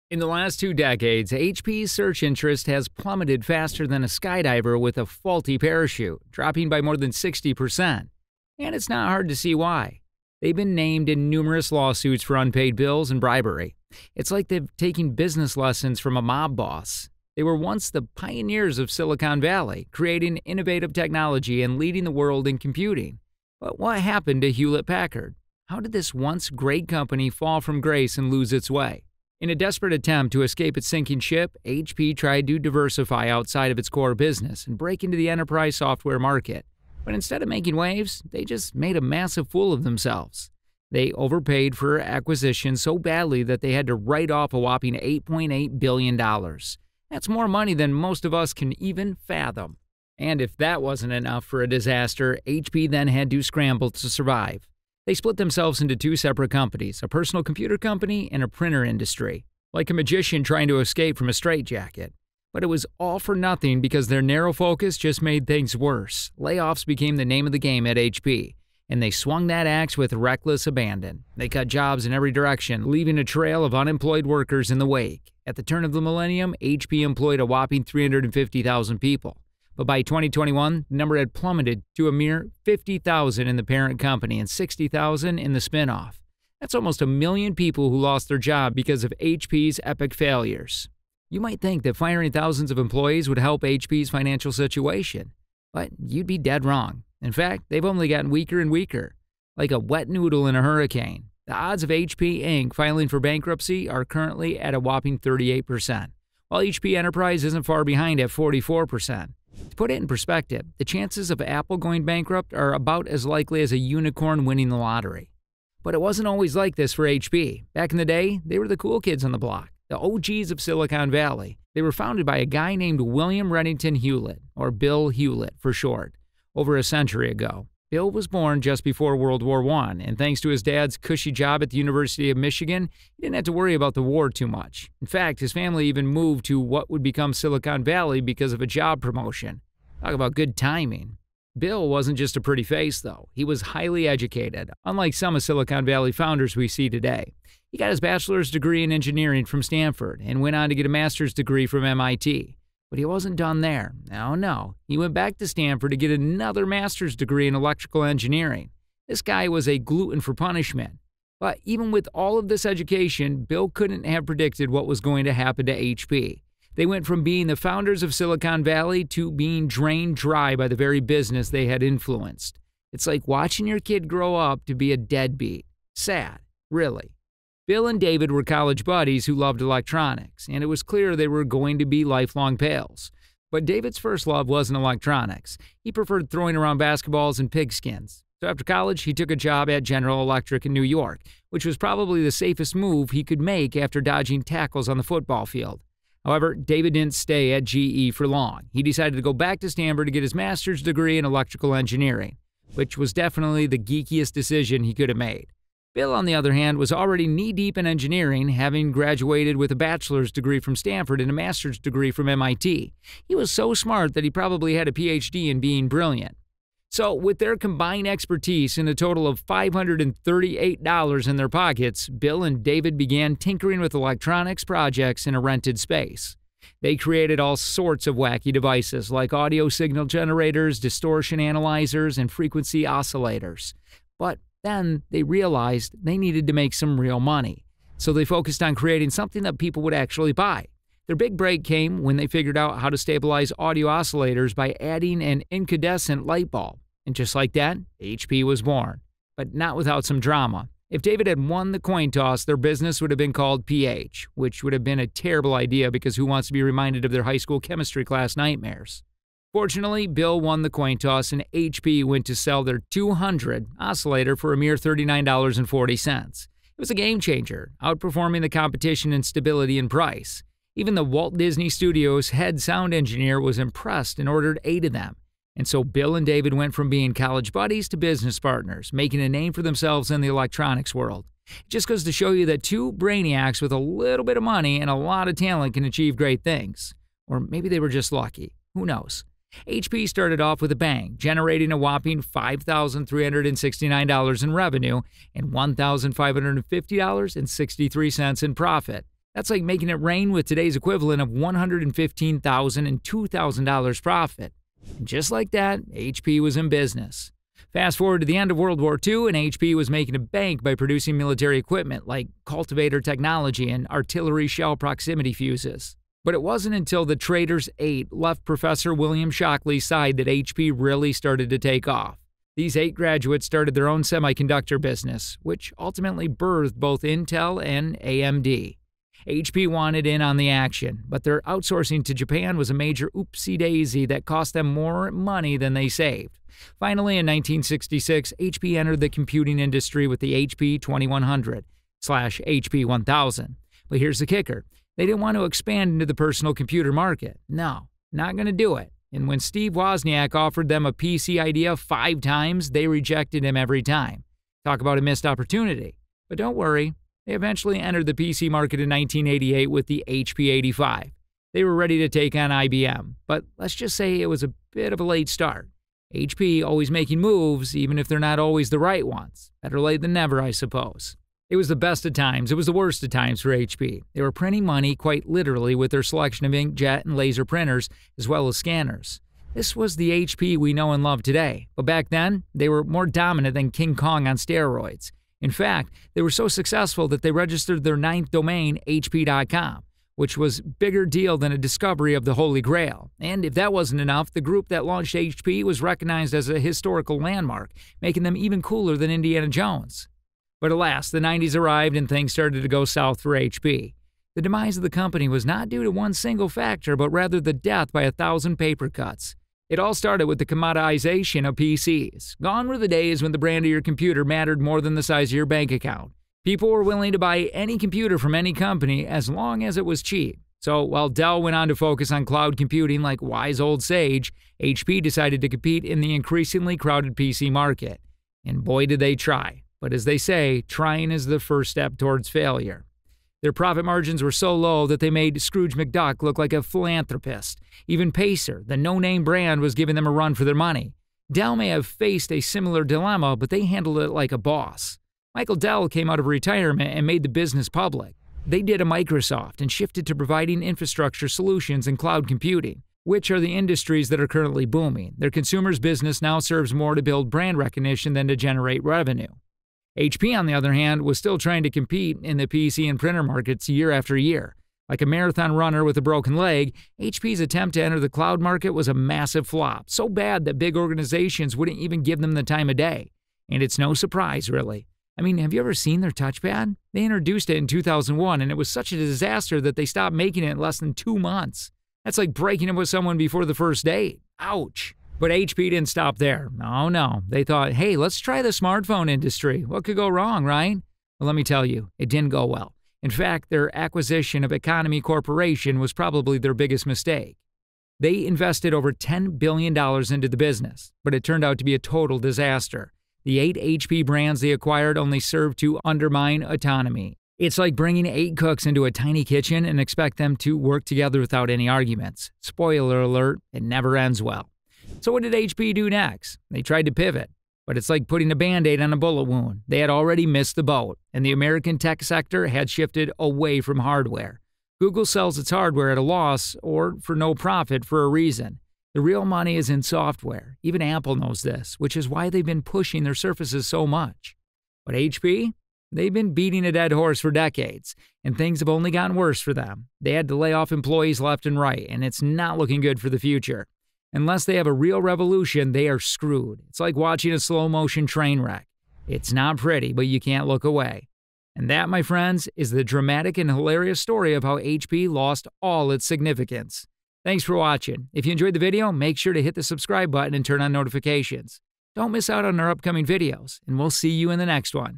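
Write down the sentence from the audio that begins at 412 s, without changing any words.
Gone were the days when the brand of your computer mattered more than the size of your bank account.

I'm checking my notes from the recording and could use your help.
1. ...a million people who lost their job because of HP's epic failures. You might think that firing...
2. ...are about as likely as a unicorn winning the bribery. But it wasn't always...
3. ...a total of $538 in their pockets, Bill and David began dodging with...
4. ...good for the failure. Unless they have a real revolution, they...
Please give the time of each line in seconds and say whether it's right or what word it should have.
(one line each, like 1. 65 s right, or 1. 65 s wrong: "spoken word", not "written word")
1. 87 s right
2. 112 s wrong: "lottery", not "bribery"
3. 218 s wrong: "tinkering", not "dodging"
4. 542 s wrong: "future", not "failure".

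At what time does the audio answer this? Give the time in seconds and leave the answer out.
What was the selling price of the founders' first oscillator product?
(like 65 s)
264 s.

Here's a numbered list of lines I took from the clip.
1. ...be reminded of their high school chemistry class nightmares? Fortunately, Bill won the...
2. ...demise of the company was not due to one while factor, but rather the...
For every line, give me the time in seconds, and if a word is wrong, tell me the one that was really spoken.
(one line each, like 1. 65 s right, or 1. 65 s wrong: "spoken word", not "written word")
1. 256 s right
2. 404 s wrong: "single", not "while".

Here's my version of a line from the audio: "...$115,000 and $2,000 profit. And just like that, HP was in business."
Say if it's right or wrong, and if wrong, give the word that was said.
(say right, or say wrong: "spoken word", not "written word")
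right.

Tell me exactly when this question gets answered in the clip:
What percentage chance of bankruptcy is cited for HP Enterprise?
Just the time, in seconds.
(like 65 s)
108 s.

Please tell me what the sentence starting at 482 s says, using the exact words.
That's like breaking up with someone before the first date.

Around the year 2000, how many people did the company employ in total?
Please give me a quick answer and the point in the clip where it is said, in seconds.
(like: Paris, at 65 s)
350,000, at 77 s.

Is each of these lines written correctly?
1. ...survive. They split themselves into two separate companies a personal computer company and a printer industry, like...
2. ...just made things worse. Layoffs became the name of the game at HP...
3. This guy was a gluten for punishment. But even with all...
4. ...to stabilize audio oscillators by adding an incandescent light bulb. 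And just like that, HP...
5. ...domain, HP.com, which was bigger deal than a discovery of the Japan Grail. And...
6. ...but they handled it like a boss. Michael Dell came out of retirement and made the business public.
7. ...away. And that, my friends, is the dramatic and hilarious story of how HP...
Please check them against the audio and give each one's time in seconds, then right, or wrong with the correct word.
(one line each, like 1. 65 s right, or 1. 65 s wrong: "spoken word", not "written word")
1. 54 s right
2. 64 s right
3. 159 s right
4. 242 s right
5. 388 s wrong: "Holy", not "Japan"
6. 443 s right
7. 550 s right.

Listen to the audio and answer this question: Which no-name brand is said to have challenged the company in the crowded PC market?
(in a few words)
Pacer.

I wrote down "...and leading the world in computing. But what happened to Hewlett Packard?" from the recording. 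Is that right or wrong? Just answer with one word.
right.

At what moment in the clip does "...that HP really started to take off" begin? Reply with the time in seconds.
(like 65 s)
320 s.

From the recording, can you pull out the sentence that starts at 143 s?
He was highly educated, unlike some of Silicon Valley founders we see today.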